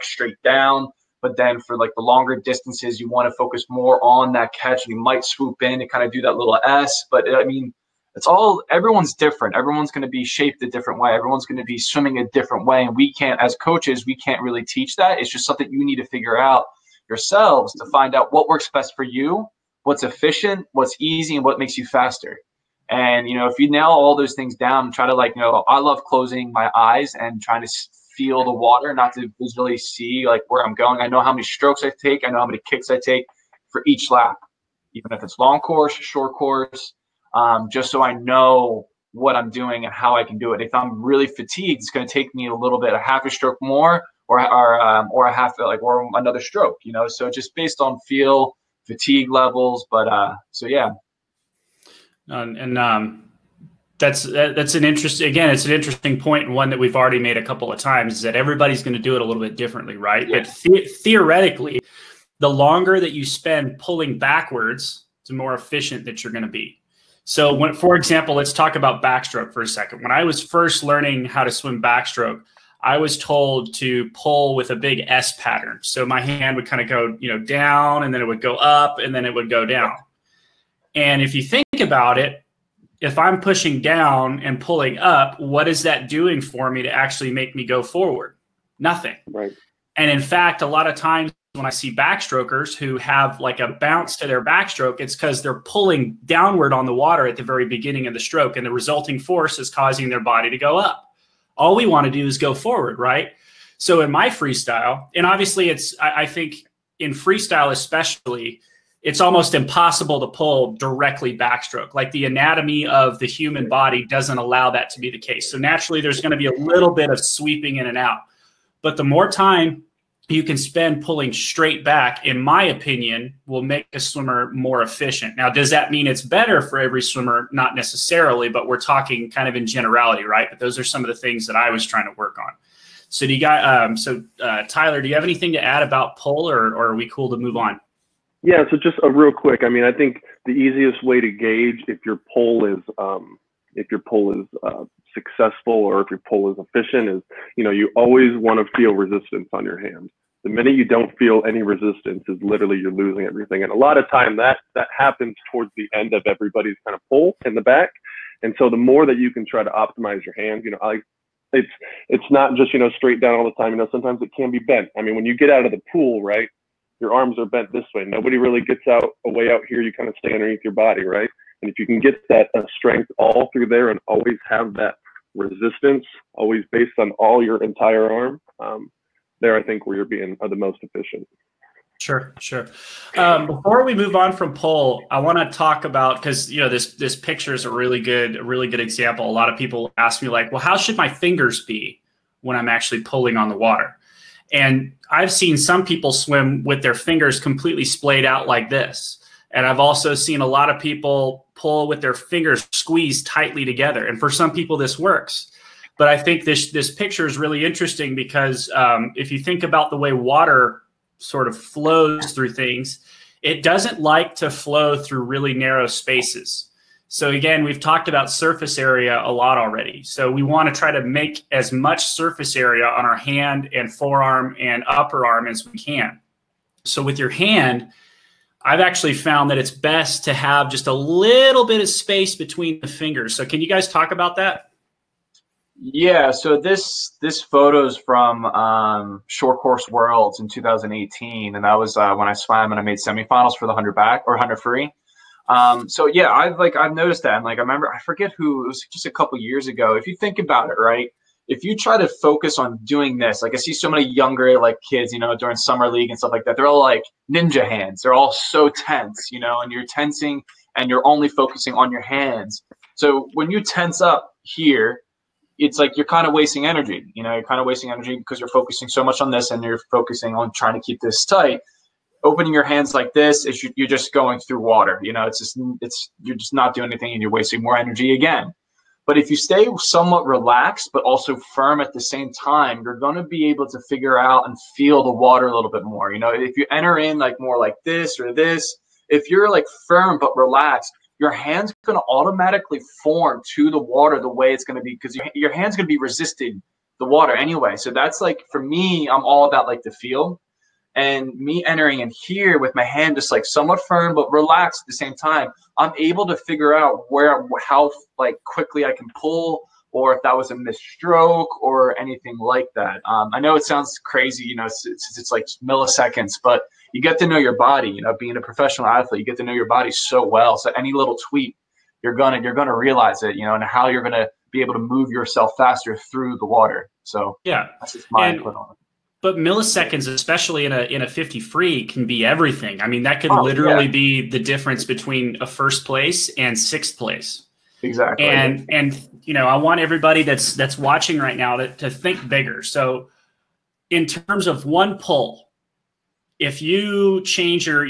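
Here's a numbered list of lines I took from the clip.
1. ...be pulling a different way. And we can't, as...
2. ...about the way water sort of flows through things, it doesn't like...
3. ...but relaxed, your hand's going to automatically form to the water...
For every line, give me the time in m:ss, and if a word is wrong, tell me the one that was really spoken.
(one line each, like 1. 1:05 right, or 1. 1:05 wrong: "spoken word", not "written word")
1. 0:11 wrong: "swimming", not "pulling"
2. 3:29 right
3. 4:50 right.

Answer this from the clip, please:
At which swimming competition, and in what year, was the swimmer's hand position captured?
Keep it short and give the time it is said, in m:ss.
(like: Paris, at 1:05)
Short Course Worlds 2018, at 3:59.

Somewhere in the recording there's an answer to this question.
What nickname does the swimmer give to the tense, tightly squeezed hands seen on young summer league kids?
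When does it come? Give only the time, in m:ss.
4:17.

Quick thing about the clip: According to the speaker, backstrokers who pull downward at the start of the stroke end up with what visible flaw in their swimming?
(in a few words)
a bounce.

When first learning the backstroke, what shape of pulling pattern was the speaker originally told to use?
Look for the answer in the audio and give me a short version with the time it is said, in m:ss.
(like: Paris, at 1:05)
big S pattern, at 1:14.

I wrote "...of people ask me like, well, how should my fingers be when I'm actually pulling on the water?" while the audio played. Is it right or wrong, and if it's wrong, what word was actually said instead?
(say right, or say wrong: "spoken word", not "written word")
right.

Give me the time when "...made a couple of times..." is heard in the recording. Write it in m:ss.
0:57.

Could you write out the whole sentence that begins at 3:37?
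So again, we've talked about surface area a lot already.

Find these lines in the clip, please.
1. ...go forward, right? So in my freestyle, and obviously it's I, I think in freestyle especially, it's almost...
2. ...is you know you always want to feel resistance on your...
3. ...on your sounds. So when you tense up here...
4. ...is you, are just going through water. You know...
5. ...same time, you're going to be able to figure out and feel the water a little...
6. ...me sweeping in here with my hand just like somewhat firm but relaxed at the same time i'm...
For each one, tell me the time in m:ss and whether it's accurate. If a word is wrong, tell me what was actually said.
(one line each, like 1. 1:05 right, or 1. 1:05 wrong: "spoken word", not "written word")
1. 1:42 right
2. 2:27 right
3. 4:21 wrong: "hands", not "sounds"
4. 4:33 right
5. 4:42 right
6. 5:01 wrong: "entering", not "sweeping".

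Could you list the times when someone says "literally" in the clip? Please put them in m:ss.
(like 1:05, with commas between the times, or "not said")
2:32, 5:33.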